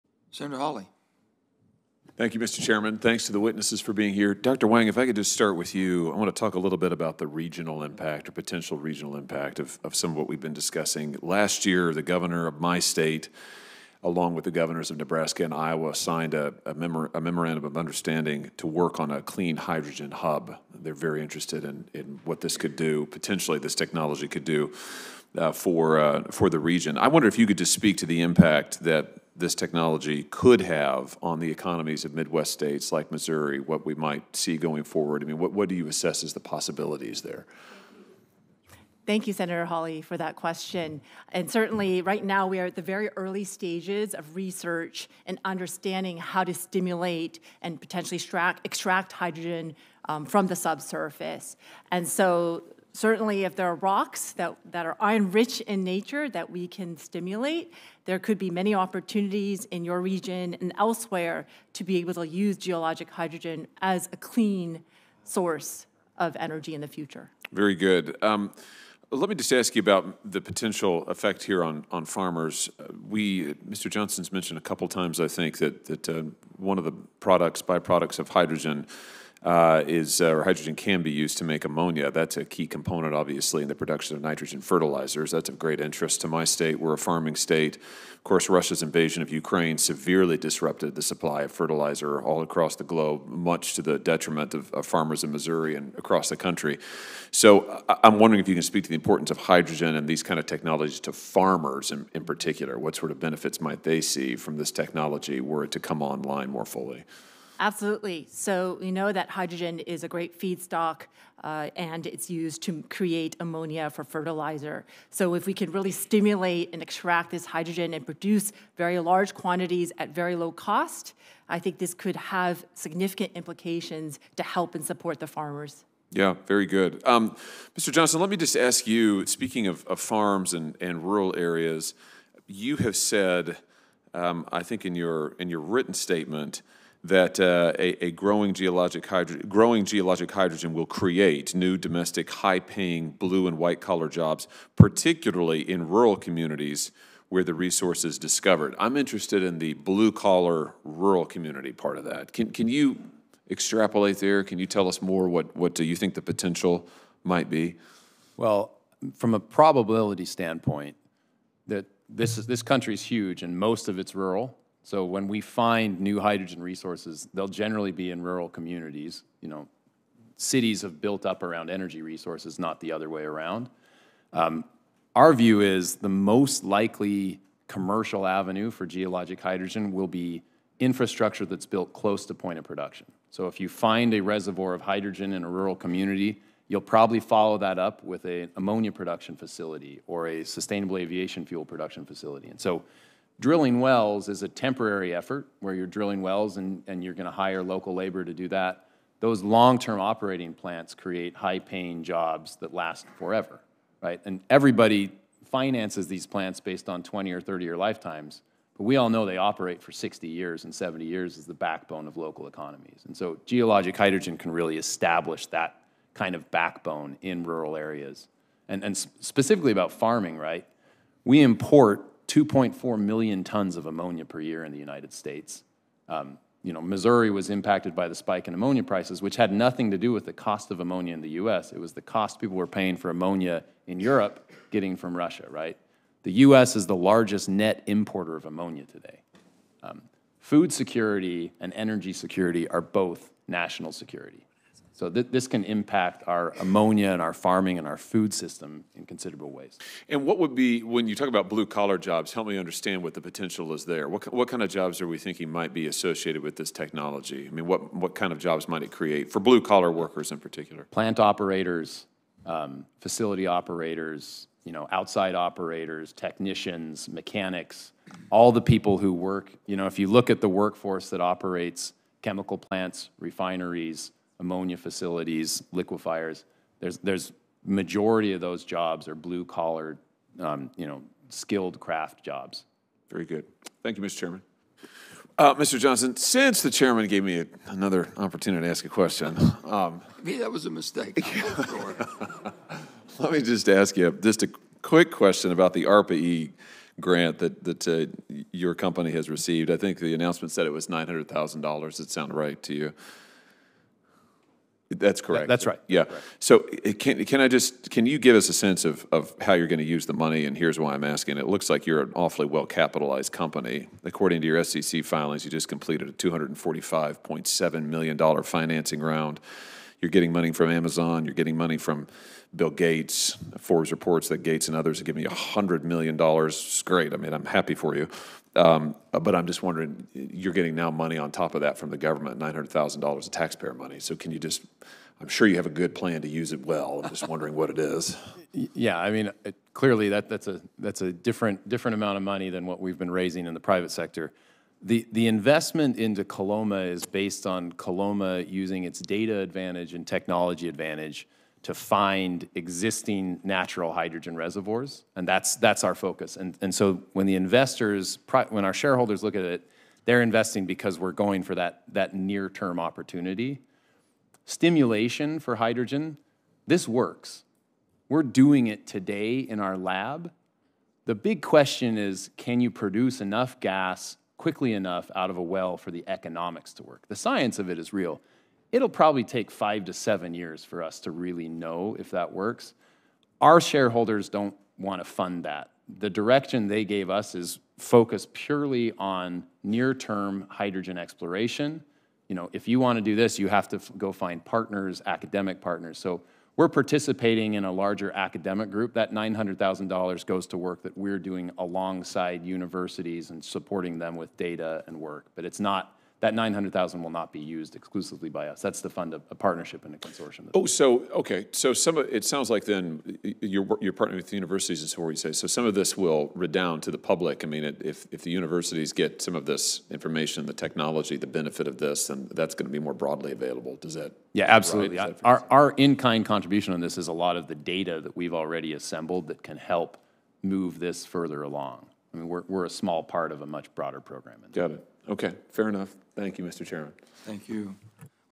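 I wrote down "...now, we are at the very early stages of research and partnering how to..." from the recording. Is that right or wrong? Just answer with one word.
wrong.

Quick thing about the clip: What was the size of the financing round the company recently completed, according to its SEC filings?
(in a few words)
$245.7 million.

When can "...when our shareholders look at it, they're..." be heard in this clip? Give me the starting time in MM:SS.
05:58.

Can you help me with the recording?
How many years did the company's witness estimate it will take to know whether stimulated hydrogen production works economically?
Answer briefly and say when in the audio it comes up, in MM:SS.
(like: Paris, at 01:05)
5 to 7 years, at 06:19.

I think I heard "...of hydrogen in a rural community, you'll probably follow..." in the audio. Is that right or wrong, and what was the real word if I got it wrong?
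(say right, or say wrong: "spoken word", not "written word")
right.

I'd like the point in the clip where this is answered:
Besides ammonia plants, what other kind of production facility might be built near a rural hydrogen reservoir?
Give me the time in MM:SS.
03:10.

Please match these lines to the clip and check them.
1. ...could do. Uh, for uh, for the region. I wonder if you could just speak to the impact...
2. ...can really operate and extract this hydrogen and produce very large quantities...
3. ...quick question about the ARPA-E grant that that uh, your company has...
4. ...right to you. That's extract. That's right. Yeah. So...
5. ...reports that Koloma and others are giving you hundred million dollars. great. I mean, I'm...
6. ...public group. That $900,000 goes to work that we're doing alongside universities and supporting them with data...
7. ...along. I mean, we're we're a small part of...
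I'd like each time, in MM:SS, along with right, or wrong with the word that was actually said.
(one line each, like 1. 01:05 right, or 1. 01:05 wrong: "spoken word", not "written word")
1. 00:24 right
2. 01:55 wrong: "stimulate", not "operate"
3. 04:54 right
4. 05:02 wrong: "correct", not "extract"
5. 05:23 wrong: "Gates", not "Koloma"
6. 06:38 wrong: "academic", not "public"
7. 07:11 right.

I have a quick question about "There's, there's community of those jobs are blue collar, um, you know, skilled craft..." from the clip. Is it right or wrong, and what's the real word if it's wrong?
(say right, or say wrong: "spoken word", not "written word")
wrong: "majority", not "community".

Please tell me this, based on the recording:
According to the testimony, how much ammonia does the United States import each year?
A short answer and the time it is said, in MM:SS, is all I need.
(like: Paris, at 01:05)
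2.4 million tons, at 03:42.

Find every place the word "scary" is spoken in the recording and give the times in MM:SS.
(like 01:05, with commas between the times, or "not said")
not said.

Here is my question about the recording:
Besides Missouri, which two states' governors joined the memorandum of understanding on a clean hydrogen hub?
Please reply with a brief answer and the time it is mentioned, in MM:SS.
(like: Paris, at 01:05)
Nebraska and Iowa, at 00:14.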